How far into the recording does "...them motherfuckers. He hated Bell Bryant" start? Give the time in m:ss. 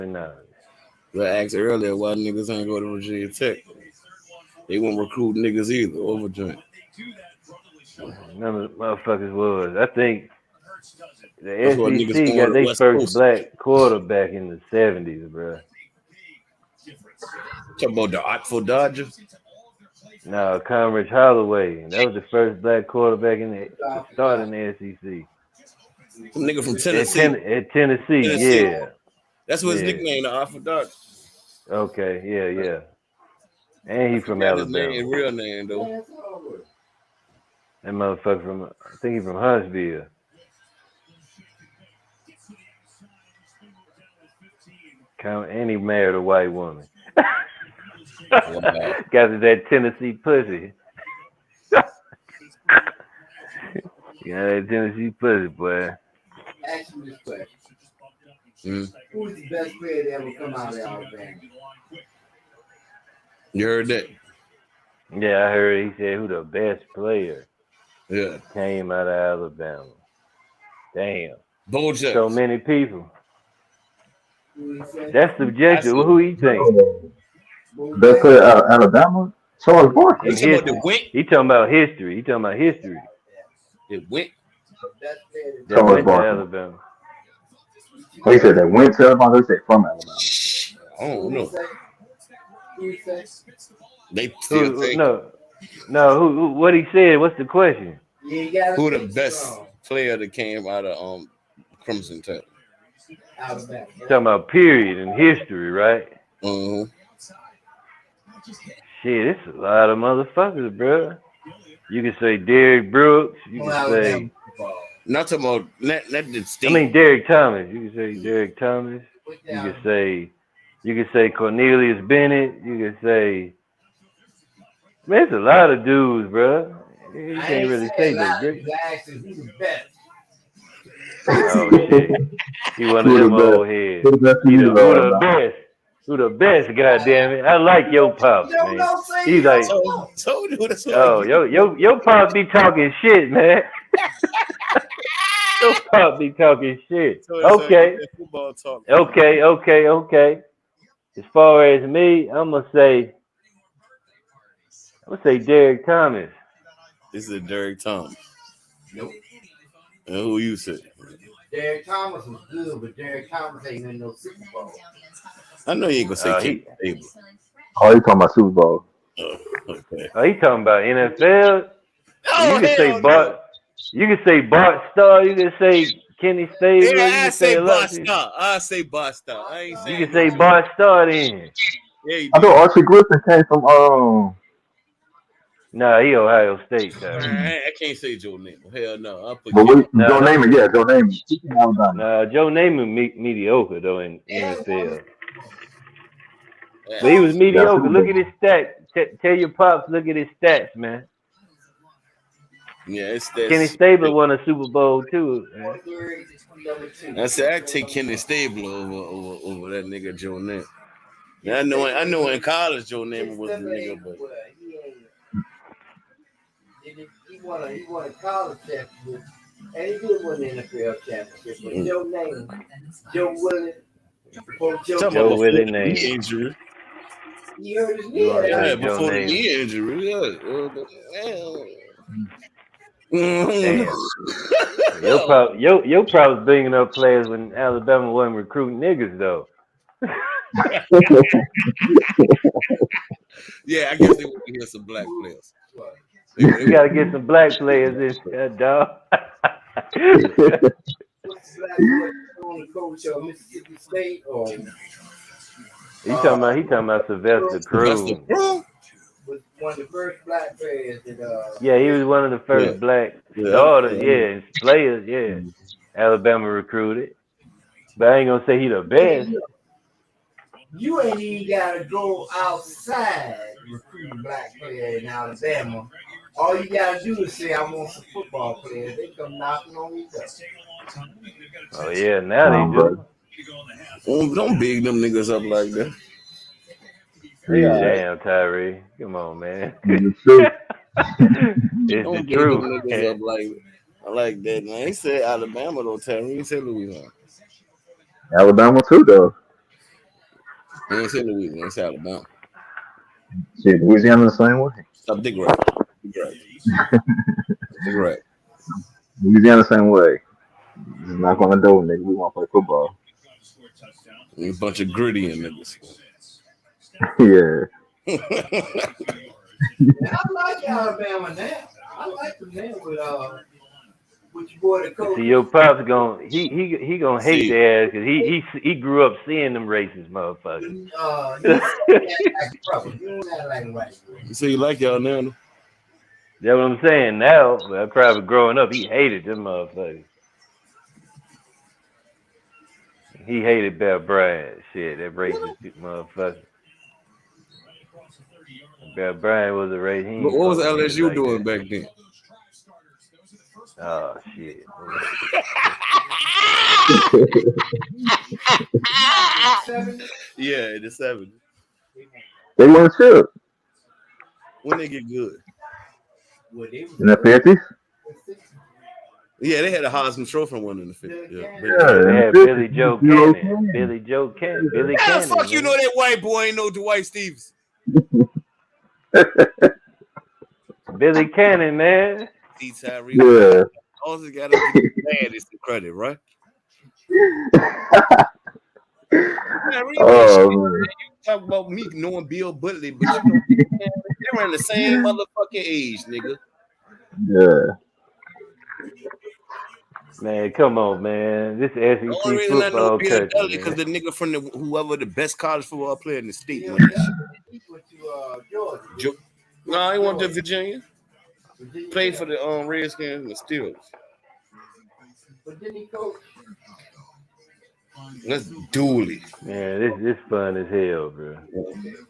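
5:39.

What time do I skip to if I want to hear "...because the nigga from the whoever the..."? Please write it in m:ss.
6:43.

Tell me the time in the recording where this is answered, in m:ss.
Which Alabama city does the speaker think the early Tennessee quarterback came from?
0:39.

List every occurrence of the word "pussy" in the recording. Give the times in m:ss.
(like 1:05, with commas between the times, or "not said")
0:50, 0:55.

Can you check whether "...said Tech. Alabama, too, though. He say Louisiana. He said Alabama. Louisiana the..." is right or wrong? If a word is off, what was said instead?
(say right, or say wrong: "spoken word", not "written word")
wrong: "Louisiana", not "Tech".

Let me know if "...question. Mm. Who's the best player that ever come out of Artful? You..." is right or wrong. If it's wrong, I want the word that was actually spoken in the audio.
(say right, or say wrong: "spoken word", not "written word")
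wrong: "Alabama", not "Artful".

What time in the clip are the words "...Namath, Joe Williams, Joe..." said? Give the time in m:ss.
3:42.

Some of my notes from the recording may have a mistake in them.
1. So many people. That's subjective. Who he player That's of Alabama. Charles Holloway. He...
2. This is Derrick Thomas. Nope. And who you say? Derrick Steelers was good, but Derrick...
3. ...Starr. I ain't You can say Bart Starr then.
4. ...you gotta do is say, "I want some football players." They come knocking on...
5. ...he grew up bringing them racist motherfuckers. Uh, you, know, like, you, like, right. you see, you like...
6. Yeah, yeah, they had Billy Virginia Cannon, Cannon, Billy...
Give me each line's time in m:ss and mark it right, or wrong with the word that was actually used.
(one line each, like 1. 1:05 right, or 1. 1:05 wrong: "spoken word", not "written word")
1. 1:12 wrong: "Barkley", not "Holloway"
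2. 2:37 wrong: "Thomas", not "Steelers"
3. 2:59 right
4. 4:36 right
5. 5:28 wrong: "seeing", not "bringing"
6. 6:11 wrong: "Joe", not "Virginia".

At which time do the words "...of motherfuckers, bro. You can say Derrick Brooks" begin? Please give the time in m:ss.
1:49.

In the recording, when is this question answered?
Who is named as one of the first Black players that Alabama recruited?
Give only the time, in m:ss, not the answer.
4:17.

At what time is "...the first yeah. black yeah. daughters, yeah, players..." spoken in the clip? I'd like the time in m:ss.
4:22.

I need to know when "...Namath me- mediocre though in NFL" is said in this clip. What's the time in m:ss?
3:12.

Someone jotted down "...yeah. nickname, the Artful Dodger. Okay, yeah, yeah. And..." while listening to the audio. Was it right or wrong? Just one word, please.
right.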